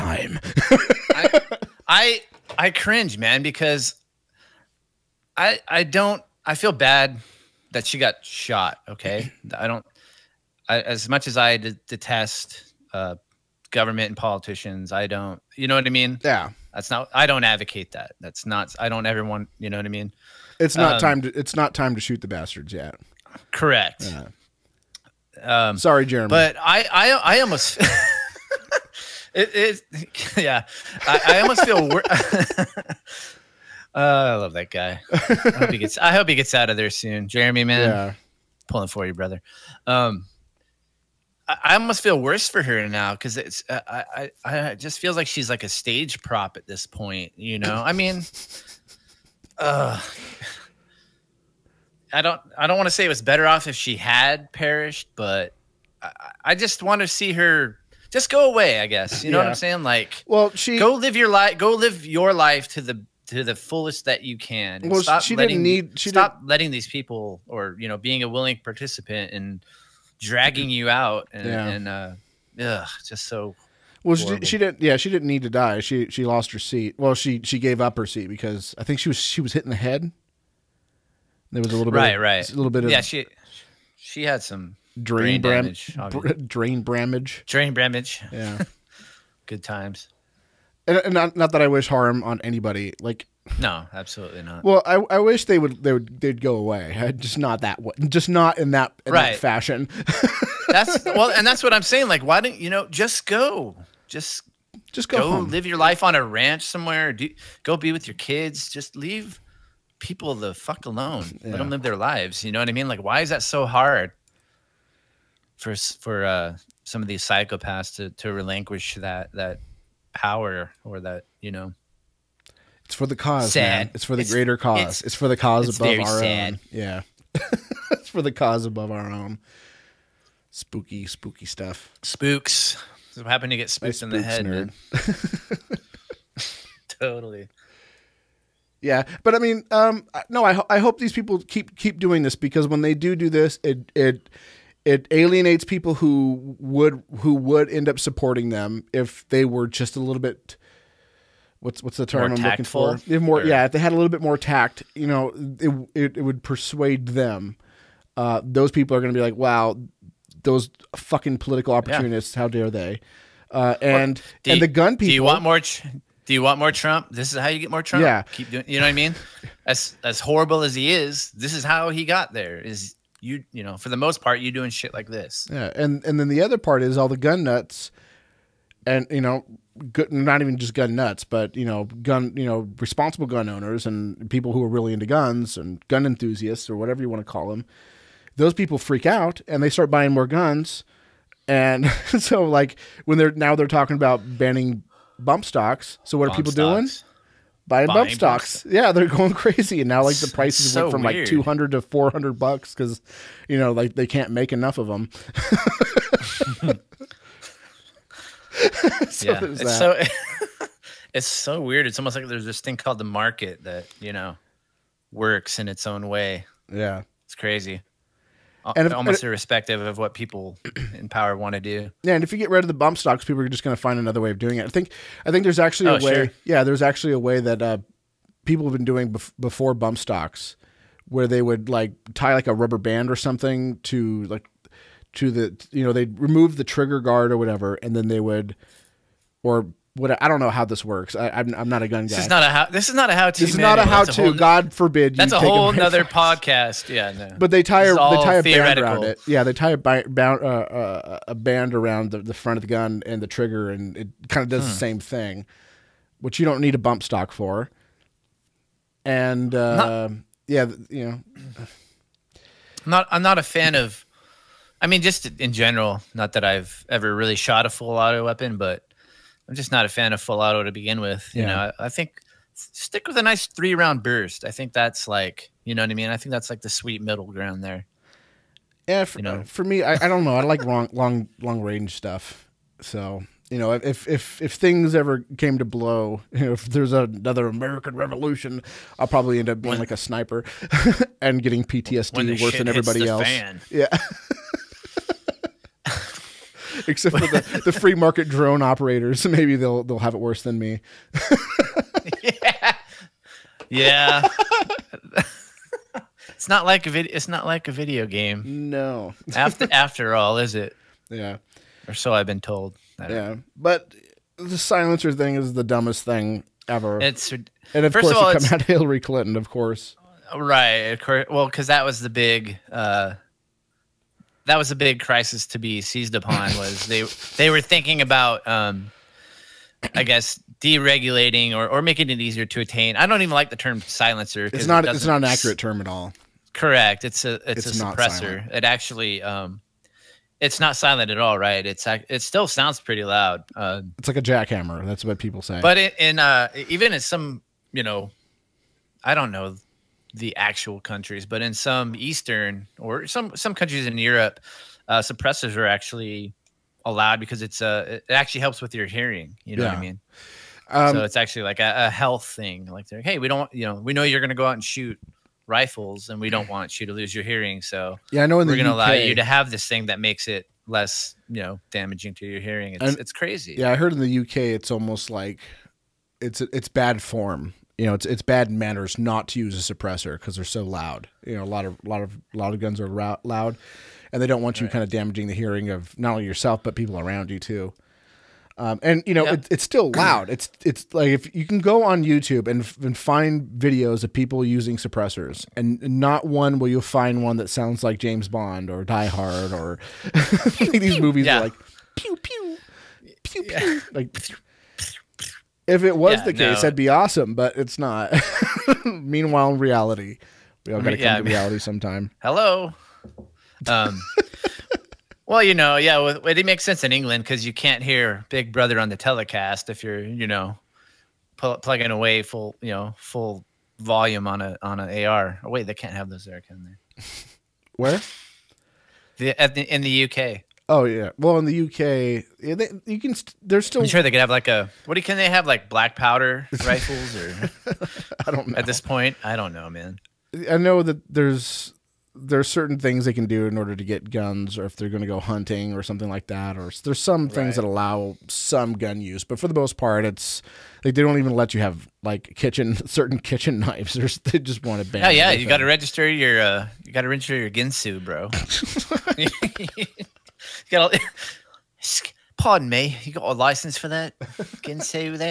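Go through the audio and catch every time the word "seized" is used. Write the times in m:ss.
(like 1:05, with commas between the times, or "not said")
5:25.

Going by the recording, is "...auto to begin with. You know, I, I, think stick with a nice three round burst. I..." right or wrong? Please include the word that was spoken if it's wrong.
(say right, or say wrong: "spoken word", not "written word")
right.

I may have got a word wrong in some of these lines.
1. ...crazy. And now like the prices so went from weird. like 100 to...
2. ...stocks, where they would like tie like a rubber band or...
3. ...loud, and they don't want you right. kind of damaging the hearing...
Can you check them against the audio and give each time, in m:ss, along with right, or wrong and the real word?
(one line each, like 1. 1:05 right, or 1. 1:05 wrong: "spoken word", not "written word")
1. 3:19 wrong: "200", not "100"
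2. 3:49 right
3. 6:22 right.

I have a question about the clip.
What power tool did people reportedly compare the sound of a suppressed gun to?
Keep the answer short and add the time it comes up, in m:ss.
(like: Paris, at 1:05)
jackhammer, at 5:44.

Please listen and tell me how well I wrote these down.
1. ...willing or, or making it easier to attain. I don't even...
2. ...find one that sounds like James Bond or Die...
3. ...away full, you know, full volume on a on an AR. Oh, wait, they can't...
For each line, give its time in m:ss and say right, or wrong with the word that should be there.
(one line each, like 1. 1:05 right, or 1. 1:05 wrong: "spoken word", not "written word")
1. 5:30 wrong: "deregulating", not "willing"
2. 6:36 right
3. 7:01 right.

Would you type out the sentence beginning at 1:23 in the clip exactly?
She she had some drain brain damage, br- drain bramage, drain bramage.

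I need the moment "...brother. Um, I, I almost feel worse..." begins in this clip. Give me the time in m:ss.
0:39.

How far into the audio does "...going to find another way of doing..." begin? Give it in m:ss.
3:43.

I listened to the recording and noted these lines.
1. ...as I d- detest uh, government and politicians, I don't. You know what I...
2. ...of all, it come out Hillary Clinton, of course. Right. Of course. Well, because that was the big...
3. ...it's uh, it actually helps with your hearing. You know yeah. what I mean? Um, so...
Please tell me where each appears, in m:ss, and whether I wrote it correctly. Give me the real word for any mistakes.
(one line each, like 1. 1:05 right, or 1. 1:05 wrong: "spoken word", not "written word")
1. 0:11 right
2. 5:18 right
3. 5:57 right.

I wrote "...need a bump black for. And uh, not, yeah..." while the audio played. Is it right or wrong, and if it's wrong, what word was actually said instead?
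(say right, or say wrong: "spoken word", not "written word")
wrong: "stock", not "black".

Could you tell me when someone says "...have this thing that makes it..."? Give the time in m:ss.
6:09.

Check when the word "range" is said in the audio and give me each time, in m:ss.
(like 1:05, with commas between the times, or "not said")
4:41.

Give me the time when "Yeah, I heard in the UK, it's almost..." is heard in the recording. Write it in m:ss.
6:13.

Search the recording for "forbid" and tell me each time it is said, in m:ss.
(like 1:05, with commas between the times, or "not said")
4:04.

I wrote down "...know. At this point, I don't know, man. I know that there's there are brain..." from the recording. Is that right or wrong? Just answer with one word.
wrong.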